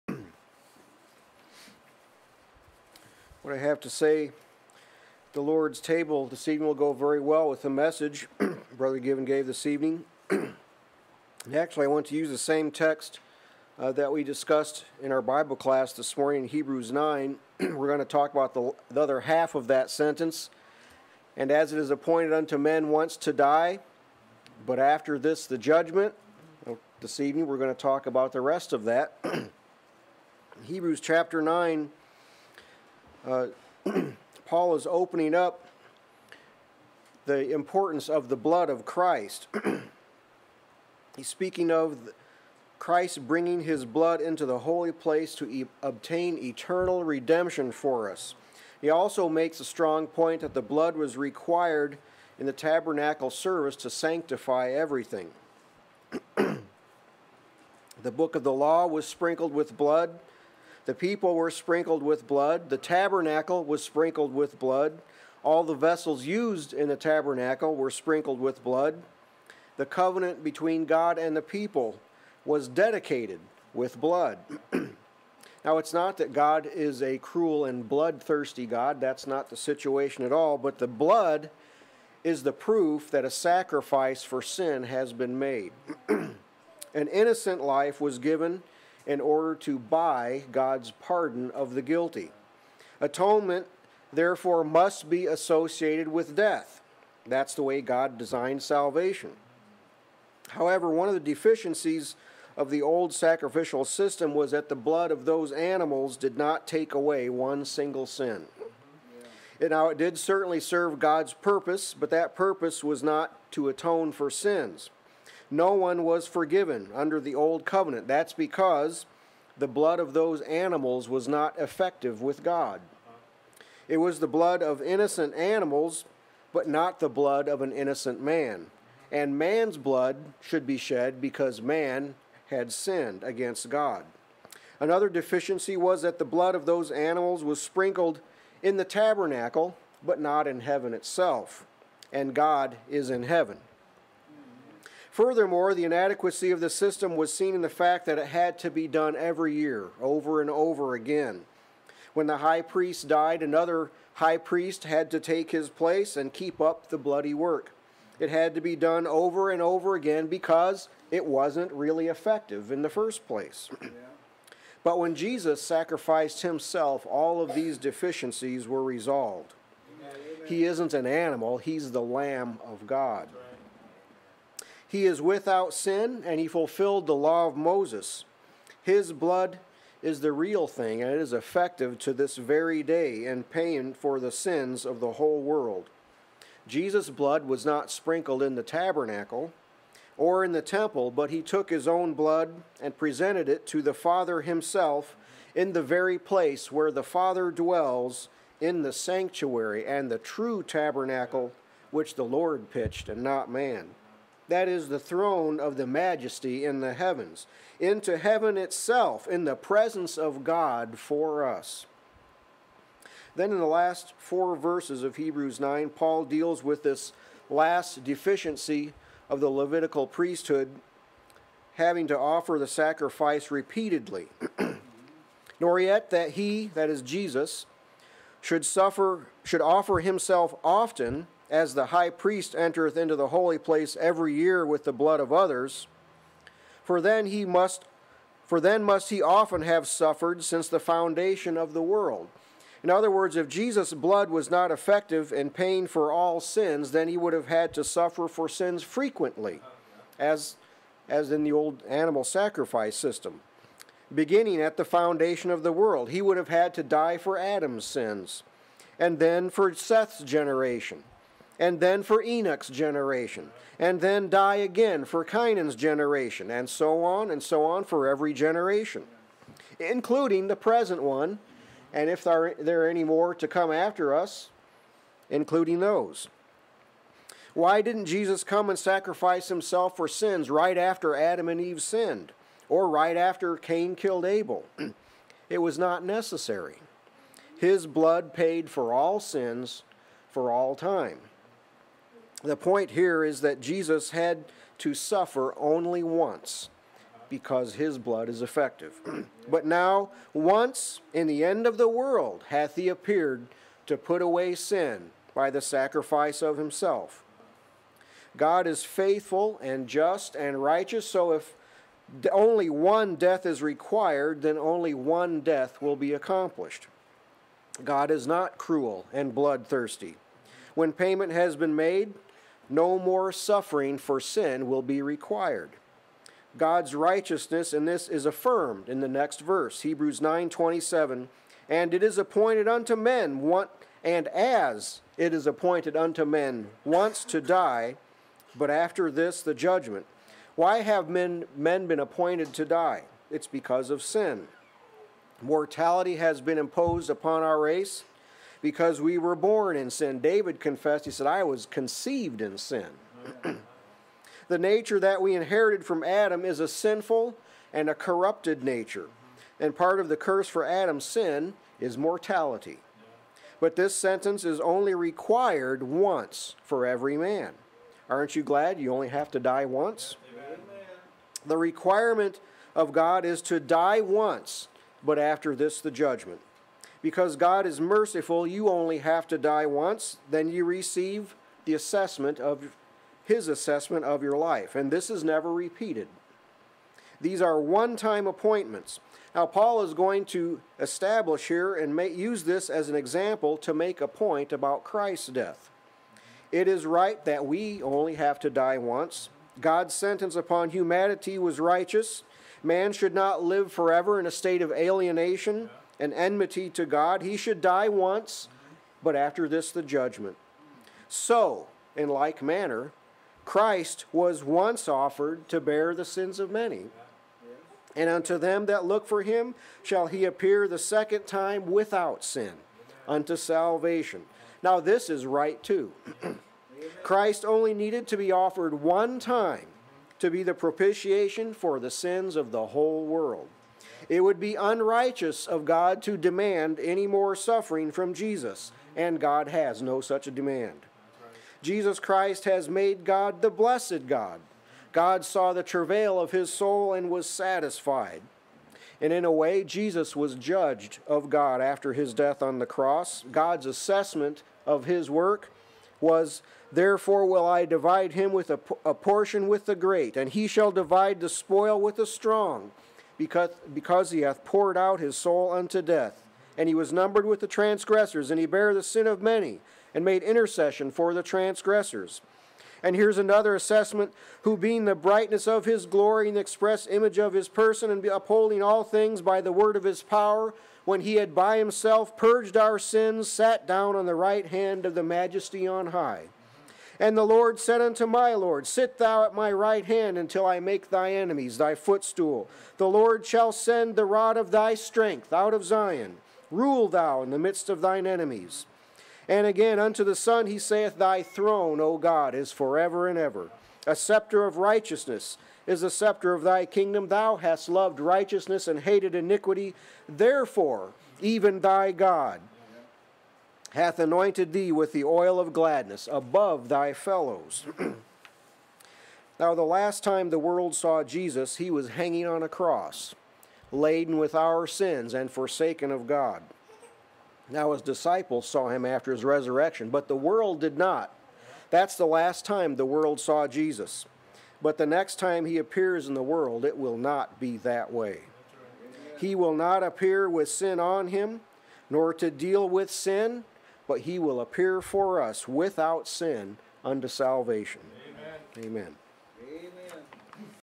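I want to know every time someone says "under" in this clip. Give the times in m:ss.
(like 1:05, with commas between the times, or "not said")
1:56.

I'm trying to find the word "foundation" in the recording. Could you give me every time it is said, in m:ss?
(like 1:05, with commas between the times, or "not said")
4:00, 4:14.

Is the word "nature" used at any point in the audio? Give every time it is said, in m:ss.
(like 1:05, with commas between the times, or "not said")
5:54, 5:58.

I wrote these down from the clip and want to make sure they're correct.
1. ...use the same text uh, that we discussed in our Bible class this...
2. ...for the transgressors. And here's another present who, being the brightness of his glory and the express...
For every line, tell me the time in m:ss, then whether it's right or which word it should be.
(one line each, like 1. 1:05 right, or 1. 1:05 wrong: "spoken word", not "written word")
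1. 0:12 right
2. 7:50 wrong: "assessment", not "present".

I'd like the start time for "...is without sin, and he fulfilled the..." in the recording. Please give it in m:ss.
2:55.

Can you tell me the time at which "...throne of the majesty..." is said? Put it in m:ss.
3:24.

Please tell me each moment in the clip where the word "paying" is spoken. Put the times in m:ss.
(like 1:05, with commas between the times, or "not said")
3:03, 4:05.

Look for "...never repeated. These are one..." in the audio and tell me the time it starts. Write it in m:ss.
6:25.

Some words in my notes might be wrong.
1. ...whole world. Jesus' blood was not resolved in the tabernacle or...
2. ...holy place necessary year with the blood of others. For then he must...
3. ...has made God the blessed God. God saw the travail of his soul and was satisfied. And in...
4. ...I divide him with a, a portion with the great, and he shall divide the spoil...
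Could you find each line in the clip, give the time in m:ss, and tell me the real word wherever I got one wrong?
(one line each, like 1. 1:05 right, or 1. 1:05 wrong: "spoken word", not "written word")
1. 3:05 wrong: "sprinkled", not "resolved"
2. 3:53 wrong: "every", not "necessary"
3. 7:22 right
4. 7:37 right.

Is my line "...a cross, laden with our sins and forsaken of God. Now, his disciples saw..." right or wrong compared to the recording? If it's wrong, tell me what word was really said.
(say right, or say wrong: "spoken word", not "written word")
right.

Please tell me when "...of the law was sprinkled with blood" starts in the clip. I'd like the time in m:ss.
0:58.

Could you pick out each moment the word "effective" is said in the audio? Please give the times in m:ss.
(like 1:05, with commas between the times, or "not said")
2:01, 2:42, 3:01, 4:04, 4:58.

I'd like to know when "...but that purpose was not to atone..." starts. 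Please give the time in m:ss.
1:51.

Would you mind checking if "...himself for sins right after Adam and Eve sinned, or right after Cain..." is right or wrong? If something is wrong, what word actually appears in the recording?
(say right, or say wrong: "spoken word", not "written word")
right.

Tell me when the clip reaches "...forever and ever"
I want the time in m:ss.
8:22.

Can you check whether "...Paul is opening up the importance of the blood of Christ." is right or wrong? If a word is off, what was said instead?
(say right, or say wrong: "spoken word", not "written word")
right.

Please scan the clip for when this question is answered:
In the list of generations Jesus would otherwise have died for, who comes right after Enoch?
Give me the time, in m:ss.
4:25.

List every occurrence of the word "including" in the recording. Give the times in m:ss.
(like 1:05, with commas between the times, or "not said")
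4:29, 4:35.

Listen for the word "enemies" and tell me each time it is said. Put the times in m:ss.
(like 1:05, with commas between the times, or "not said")
8:11, 8:18.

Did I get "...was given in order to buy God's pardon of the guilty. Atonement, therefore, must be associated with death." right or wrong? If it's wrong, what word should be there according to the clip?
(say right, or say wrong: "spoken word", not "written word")
right.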